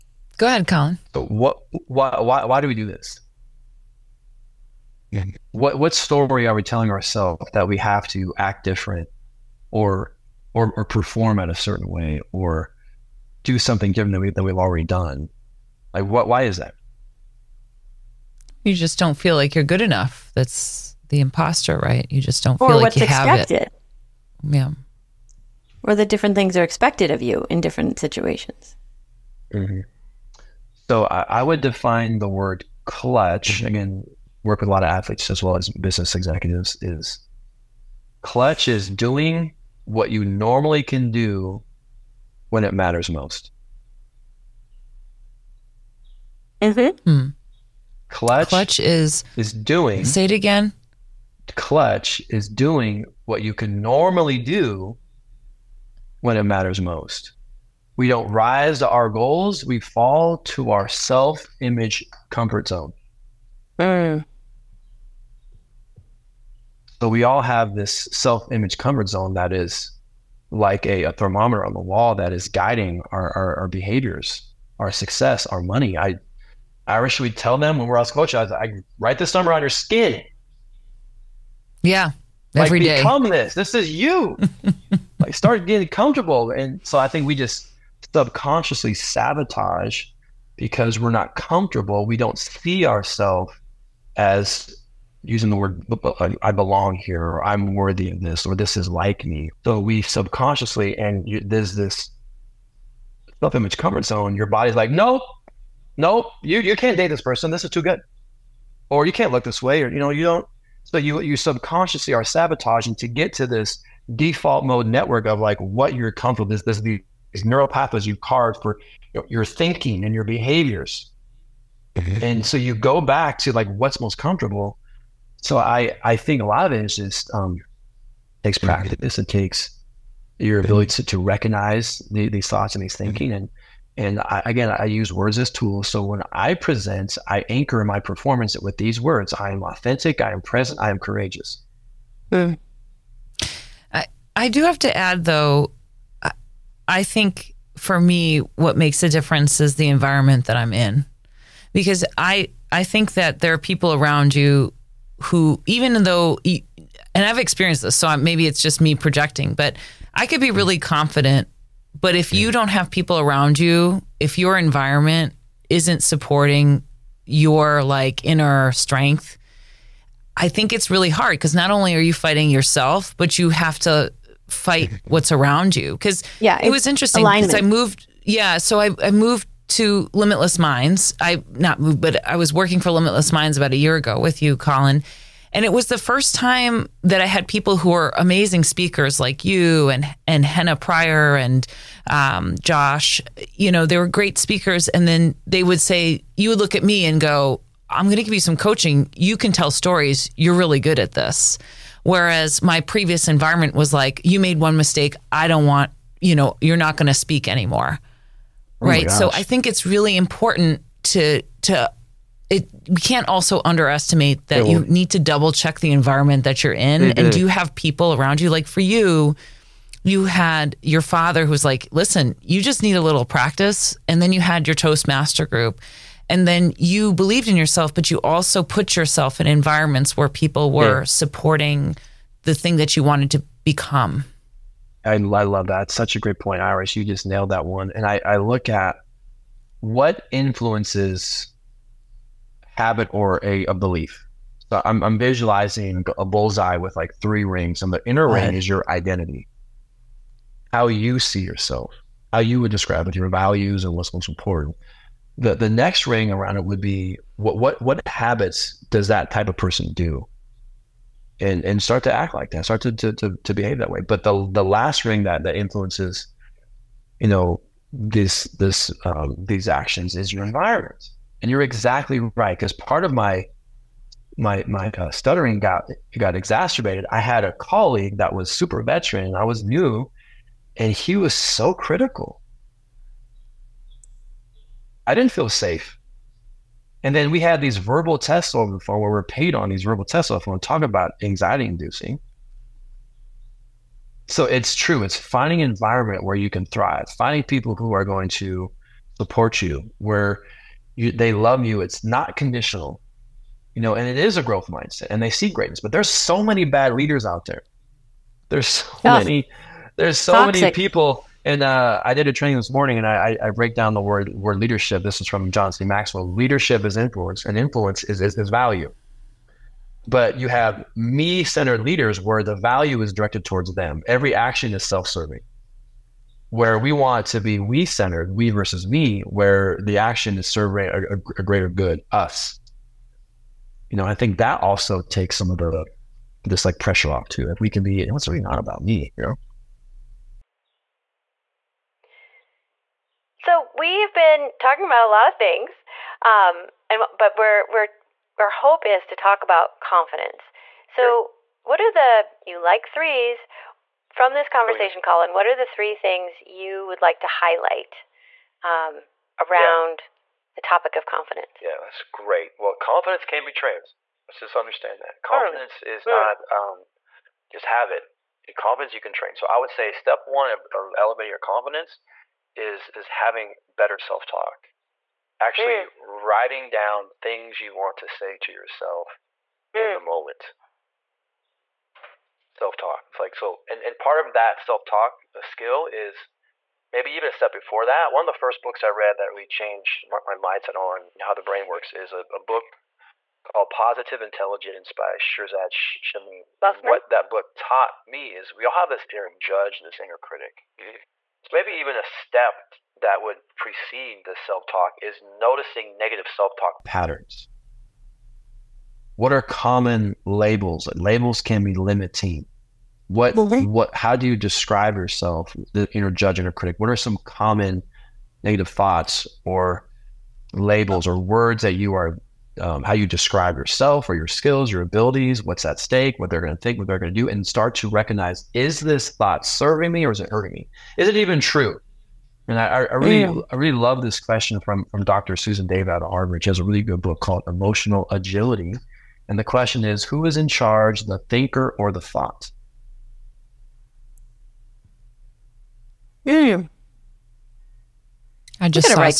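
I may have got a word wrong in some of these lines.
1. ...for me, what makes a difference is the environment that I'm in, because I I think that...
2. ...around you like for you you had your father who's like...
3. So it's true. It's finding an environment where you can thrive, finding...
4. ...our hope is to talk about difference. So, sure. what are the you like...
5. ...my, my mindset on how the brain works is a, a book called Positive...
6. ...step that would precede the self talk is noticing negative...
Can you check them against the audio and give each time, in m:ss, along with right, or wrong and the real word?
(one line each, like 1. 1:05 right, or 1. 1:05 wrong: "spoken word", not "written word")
1. 2:27 right
2. 3:38 right
3. 4:54 right
4. 5:48 wrong: "confidence", not "difference"
5. 6:30 right
6. 6:42 right.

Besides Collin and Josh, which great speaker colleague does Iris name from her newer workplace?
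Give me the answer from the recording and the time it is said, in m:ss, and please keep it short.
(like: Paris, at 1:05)
Henna Pryor, at 3:10.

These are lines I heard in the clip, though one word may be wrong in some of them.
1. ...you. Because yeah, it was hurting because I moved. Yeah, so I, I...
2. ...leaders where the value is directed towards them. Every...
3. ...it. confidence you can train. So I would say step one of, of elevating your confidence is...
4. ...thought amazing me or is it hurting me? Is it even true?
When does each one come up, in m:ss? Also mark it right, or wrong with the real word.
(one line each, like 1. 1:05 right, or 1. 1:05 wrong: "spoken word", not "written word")
1. 2:55 wrong: "interesting", not "hurting"
2. 5:21 right
3. 6:07 right
4. 7:09 wrong: "serving", not "amazing".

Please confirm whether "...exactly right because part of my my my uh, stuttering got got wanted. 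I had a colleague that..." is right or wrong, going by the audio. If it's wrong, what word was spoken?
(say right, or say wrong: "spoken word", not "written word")
wrong: "exacerbated", not "wanted".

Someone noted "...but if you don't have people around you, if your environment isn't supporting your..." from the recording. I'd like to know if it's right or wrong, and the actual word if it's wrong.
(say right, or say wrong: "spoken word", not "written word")
right.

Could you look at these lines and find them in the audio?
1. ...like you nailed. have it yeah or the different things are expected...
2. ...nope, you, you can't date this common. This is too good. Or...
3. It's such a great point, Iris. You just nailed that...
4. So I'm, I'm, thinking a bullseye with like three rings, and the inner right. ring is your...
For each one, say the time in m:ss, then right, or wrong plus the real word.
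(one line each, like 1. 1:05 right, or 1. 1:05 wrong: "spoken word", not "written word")
1. 0:22 wrong: "expected", not "nailed"
2. 1:45 wrong: "person", not "common"
3. 3:55 right
4. 4:04 wrong: "visualizing", not "thinking".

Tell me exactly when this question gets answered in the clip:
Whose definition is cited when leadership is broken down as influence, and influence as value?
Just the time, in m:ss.
5:15.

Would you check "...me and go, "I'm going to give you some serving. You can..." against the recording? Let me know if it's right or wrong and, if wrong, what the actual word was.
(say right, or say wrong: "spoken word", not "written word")
wrong: "coaching", not "serving".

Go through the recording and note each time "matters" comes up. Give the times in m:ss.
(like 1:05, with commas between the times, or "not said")
0:42, 0:56.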